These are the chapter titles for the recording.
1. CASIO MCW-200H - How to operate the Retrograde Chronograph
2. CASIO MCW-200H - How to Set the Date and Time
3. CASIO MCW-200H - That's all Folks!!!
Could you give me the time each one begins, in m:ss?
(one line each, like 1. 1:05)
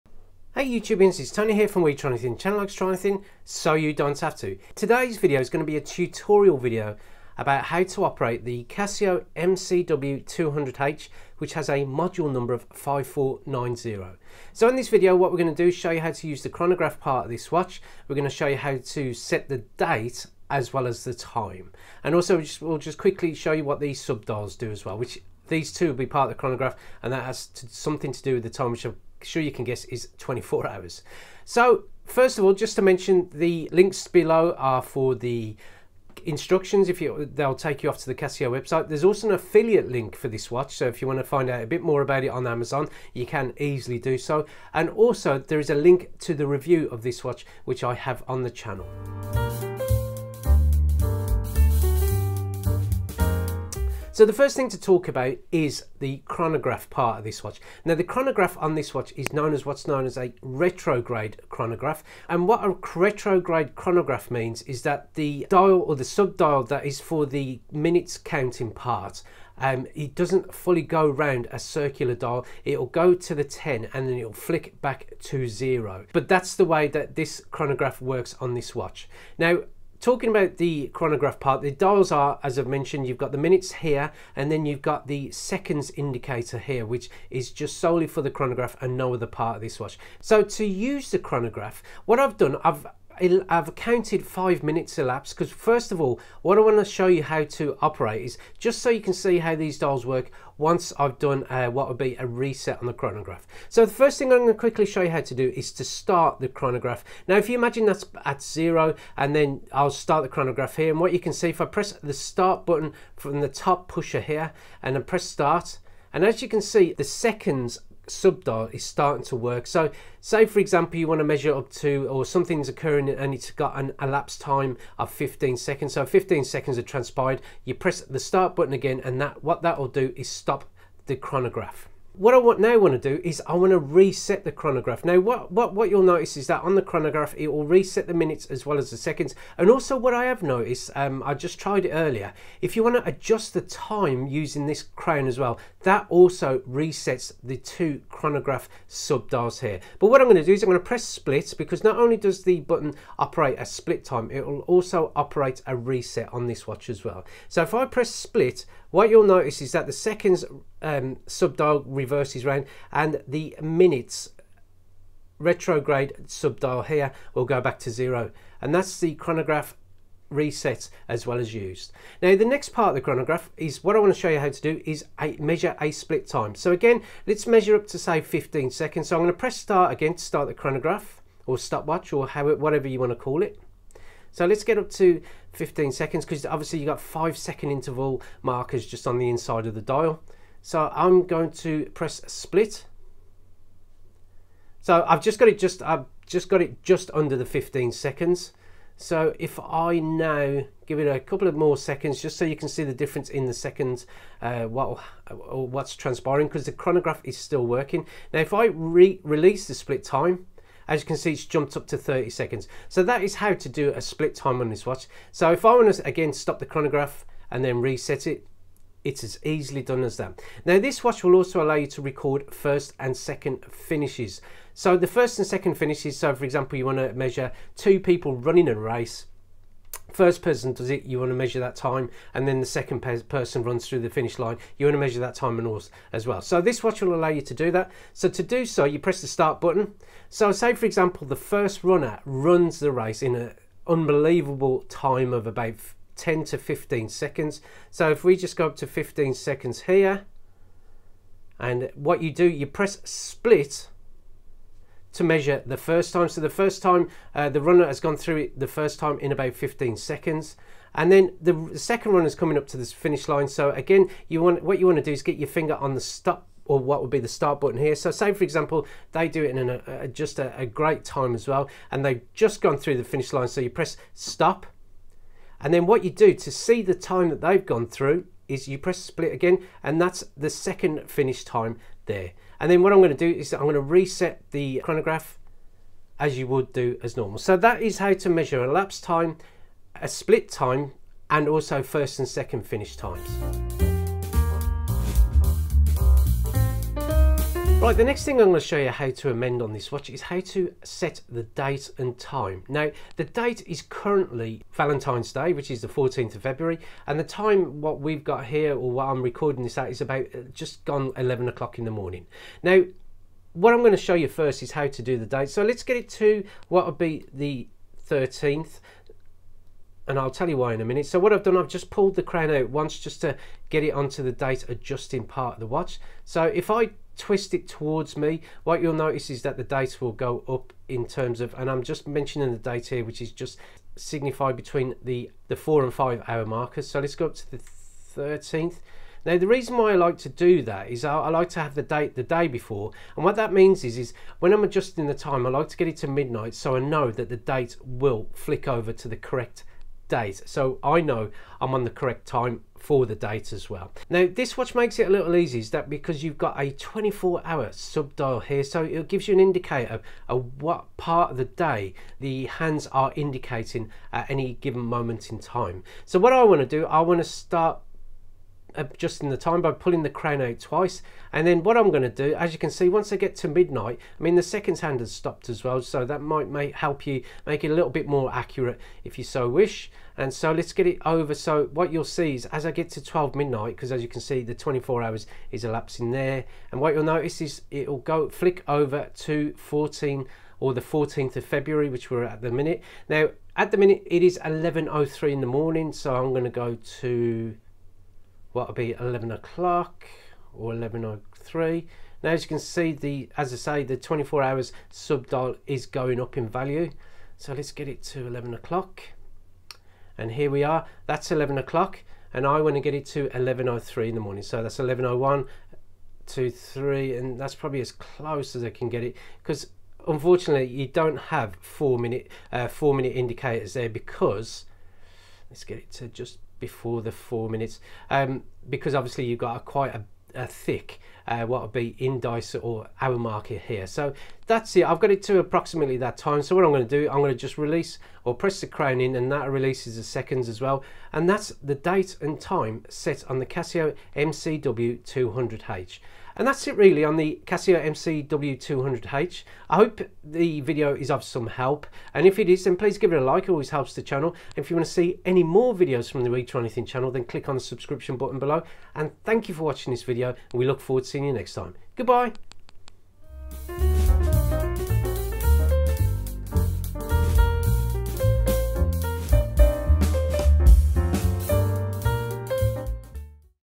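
1. 0:49
2. 4:54
3. 7:25.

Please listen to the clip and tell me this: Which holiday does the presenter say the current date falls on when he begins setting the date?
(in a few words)
Valentine's Day.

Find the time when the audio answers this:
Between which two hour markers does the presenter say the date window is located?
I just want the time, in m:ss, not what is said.
5:35.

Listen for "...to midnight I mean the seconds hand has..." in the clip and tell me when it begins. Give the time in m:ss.
6:13.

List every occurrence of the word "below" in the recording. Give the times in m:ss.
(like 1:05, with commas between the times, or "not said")
0:34, 7:38.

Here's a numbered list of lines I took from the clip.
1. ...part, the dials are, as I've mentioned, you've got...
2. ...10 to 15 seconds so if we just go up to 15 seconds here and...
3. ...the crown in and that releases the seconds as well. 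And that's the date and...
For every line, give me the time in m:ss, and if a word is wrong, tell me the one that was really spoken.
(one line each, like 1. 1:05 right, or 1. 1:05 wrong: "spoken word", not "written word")
1. 1:21 right
2. 4:06 right
3. 7:18 right.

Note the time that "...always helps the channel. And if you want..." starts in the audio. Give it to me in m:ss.
7:33.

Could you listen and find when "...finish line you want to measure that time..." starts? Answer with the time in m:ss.
3:54.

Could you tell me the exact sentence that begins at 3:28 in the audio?
Now, if I re release the split time, as you can see, it's jumped up to 30 seconds.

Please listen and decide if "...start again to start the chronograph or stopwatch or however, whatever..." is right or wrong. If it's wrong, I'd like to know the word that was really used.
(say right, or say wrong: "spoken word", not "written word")
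right.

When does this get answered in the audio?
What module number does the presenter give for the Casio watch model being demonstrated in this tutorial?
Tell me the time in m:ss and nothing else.
0:12.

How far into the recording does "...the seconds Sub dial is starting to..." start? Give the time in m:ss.
1:56.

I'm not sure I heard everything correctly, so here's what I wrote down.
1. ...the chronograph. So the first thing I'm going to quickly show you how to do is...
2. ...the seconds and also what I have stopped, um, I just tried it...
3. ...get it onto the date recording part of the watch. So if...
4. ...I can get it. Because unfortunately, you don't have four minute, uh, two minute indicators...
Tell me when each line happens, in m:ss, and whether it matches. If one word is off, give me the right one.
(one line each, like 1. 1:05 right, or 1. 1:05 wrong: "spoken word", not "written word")
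1. 1:42 right
2. 2:18 wrong: "noticed", not "stopped"
3. 5:23 wrong: "adjusting", not "recording"
4. 6:58 wrong: "four", not "two".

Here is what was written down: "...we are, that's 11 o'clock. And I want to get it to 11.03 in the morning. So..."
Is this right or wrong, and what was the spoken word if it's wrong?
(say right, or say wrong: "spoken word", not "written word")
right.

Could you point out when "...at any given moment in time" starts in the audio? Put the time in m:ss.
6:04.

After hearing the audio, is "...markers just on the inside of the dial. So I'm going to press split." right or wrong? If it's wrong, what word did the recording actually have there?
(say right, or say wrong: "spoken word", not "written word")
right.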